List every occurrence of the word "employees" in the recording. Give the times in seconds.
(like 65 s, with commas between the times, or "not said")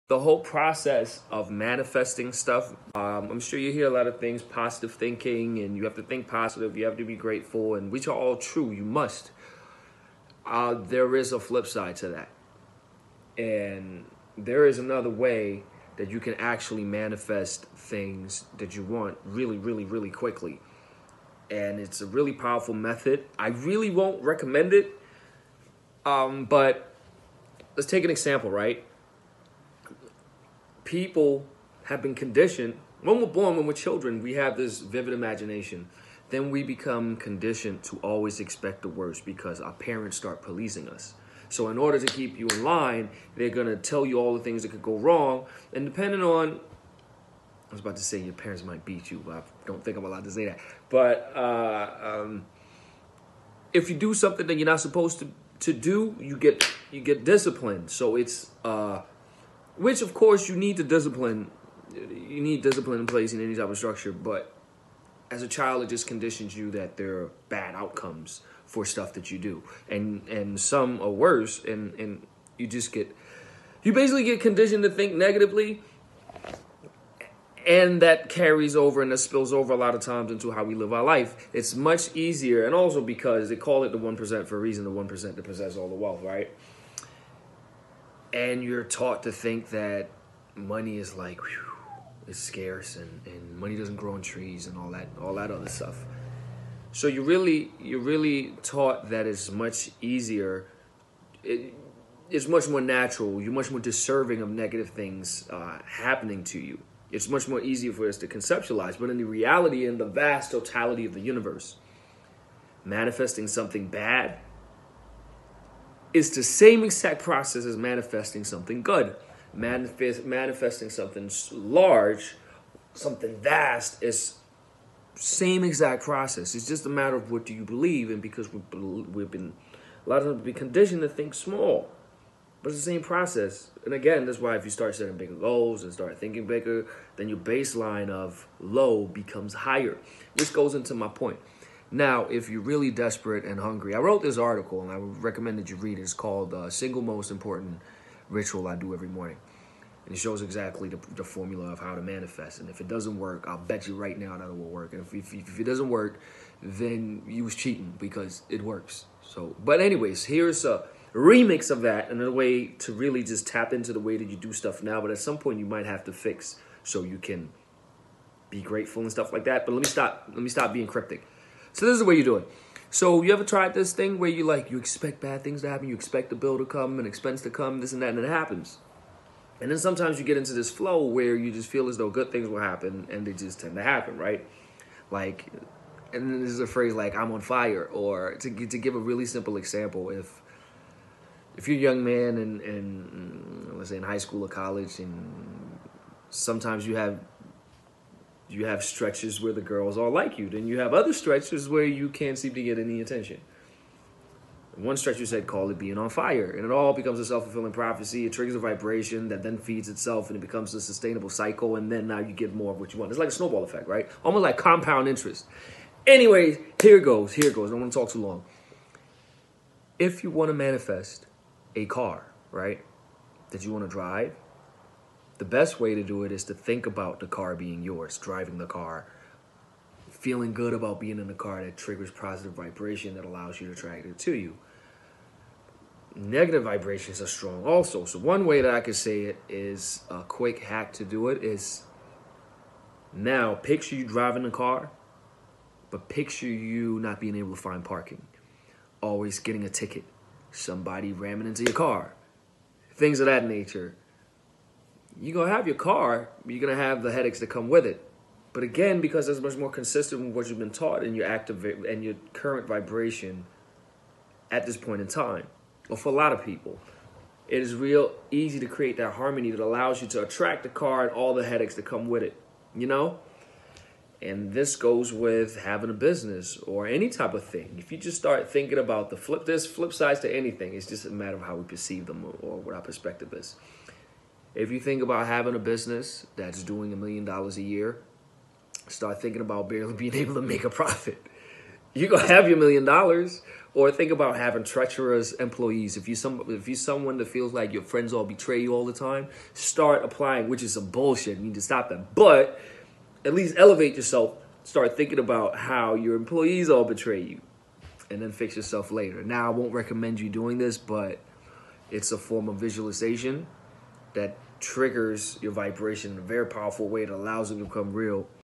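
295 s, 306 s.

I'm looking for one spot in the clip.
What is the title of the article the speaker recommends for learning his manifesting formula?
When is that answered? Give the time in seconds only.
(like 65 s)
146 s.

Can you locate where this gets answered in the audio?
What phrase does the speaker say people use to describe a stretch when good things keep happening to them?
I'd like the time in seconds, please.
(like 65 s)
187 s.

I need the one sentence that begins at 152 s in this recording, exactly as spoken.
And if it doesn't work, I'll bet you right now that it will work.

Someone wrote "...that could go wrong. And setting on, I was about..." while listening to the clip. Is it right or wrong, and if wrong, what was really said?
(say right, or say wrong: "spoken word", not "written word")
wrong: "depending", not "setting".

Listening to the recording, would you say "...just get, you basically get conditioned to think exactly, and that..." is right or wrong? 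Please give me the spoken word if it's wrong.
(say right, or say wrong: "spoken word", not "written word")
wrong: "negatively", not "exactly".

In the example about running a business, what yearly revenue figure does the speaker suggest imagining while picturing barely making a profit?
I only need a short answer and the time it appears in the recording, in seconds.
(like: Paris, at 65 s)
a million dollars, at 286 s.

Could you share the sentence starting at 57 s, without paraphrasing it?
So it's uh, which, of course, you need to discipline.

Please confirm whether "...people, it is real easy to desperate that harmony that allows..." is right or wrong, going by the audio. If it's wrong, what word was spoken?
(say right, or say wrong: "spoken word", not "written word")
wrong: "create", not "desperate".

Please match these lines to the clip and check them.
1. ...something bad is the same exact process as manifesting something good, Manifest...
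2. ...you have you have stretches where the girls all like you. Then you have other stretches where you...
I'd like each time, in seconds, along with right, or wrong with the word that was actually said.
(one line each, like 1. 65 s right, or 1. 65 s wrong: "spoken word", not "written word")
1. 113 s right
2. 196 s right.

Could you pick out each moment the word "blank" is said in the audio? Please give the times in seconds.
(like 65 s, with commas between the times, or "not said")
not said.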